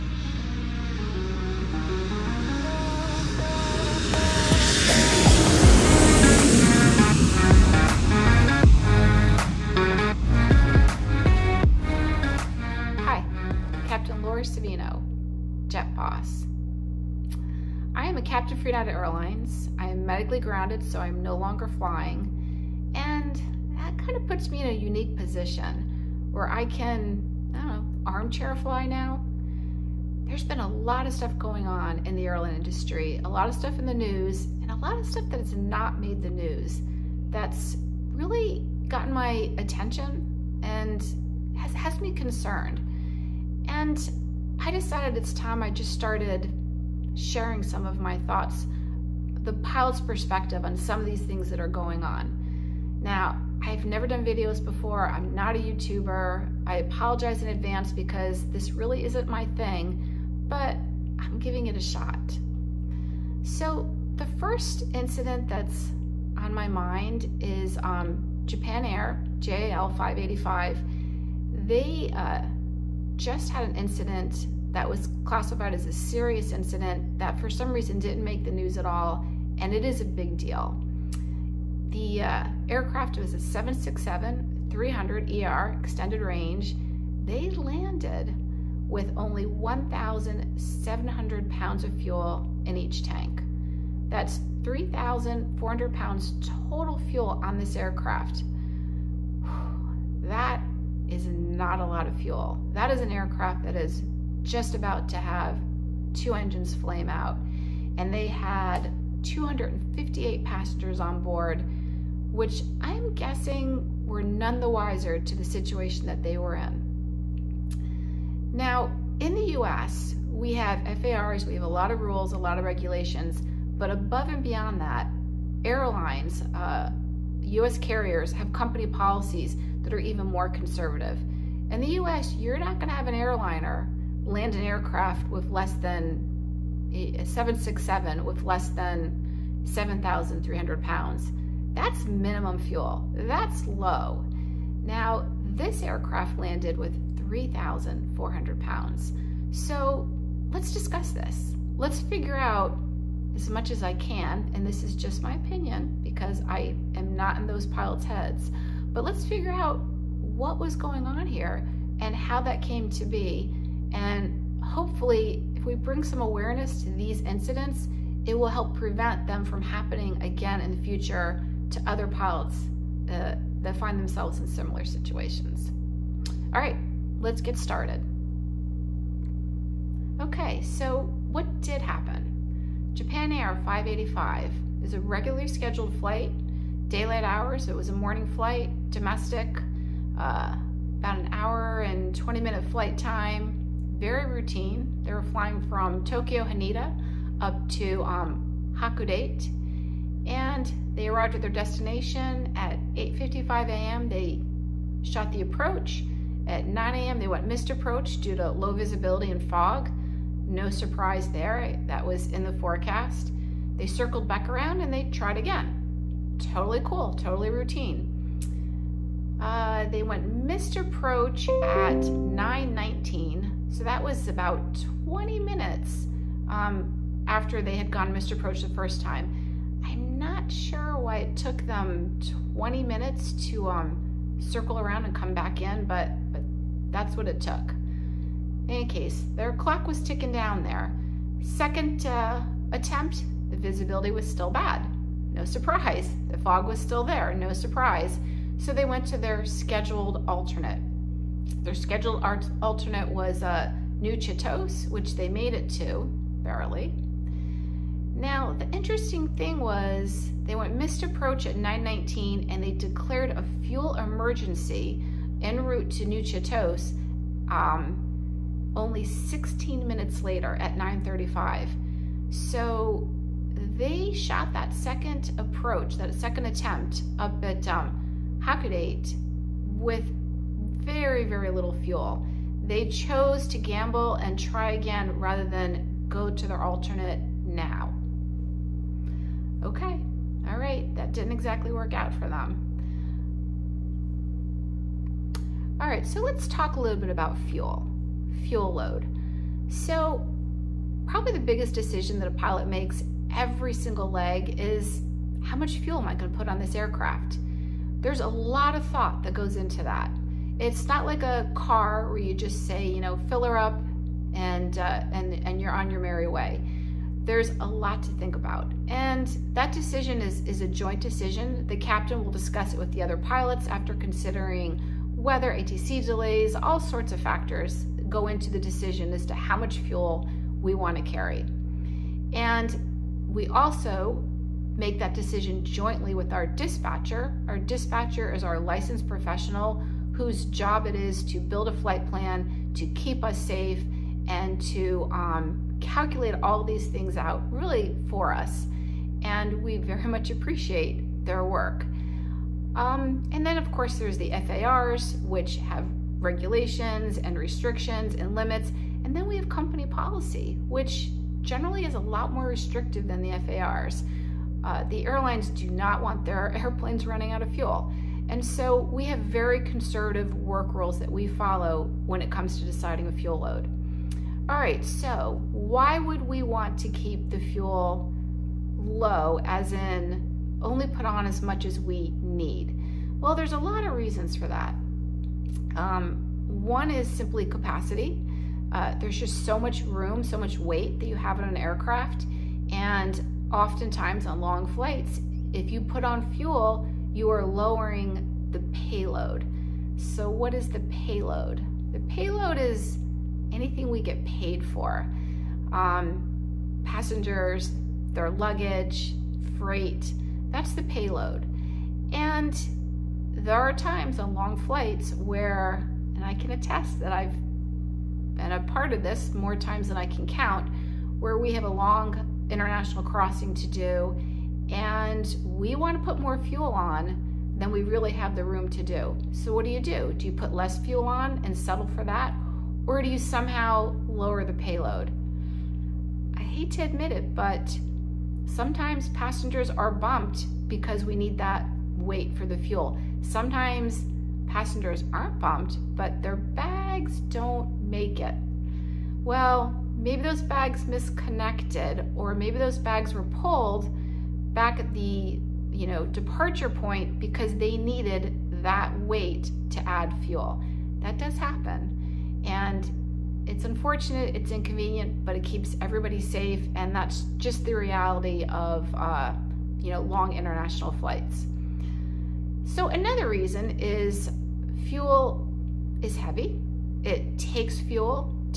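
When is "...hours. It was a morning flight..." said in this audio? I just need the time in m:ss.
3:07.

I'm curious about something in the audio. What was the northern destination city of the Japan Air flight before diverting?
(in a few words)
Hakodate.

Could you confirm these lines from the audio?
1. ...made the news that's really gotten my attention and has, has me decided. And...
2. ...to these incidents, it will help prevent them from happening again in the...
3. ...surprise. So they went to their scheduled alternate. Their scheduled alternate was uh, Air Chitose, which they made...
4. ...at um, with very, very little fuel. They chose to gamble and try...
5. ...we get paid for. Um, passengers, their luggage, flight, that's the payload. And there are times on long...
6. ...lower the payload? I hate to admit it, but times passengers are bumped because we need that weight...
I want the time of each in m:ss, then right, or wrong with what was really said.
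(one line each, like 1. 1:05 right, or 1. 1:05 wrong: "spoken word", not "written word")
1. 0:35 wrong: "concerned", not "decided"
2. 2:46 right
3. 4:07 wrong: "New", not "Air"
4. 4:37 right
5. 6:43 wrong: "freight", not "flight"
6. 7:14 wrong: "sometimes", not "times".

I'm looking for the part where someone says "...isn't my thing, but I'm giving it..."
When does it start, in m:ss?
0:59.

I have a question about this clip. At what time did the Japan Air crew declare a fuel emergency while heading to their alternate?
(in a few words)
9:35.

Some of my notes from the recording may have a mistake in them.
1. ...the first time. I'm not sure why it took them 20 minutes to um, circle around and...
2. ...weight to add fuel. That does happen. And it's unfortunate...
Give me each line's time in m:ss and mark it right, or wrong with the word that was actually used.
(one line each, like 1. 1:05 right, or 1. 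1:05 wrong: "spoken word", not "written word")
1. 3:48 right
2. 7:38 right.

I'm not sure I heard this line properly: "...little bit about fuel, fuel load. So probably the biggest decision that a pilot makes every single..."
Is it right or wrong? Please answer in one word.
right.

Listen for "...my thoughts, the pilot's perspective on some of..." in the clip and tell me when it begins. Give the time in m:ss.
0:47.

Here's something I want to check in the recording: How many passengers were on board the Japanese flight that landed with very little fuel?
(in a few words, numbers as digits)
258.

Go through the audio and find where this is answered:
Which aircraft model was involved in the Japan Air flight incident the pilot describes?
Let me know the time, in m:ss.
1:23.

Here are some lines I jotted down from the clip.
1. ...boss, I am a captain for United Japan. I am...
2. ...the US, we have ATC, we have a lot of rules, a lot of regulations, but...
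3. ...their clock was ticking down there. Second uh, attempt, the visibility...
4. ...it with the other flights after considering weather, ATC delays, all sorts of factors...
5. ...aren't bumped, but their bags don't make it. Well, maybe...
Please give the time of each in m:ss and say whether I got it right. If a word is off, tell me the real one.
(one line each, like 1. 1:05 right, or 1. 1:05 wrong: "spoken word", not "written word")
1. 0:15 wrong: "Airlines", not "Japan"
2. 1:59 wrong: "FARs", not "ATC"
3. 3:59 right
4. 5:22 wrong: "pilots", not "flights"
5. 7:25 right.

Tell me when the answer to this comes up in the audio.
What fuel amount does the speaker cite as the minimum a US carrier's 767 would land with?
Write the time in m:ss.
2:19.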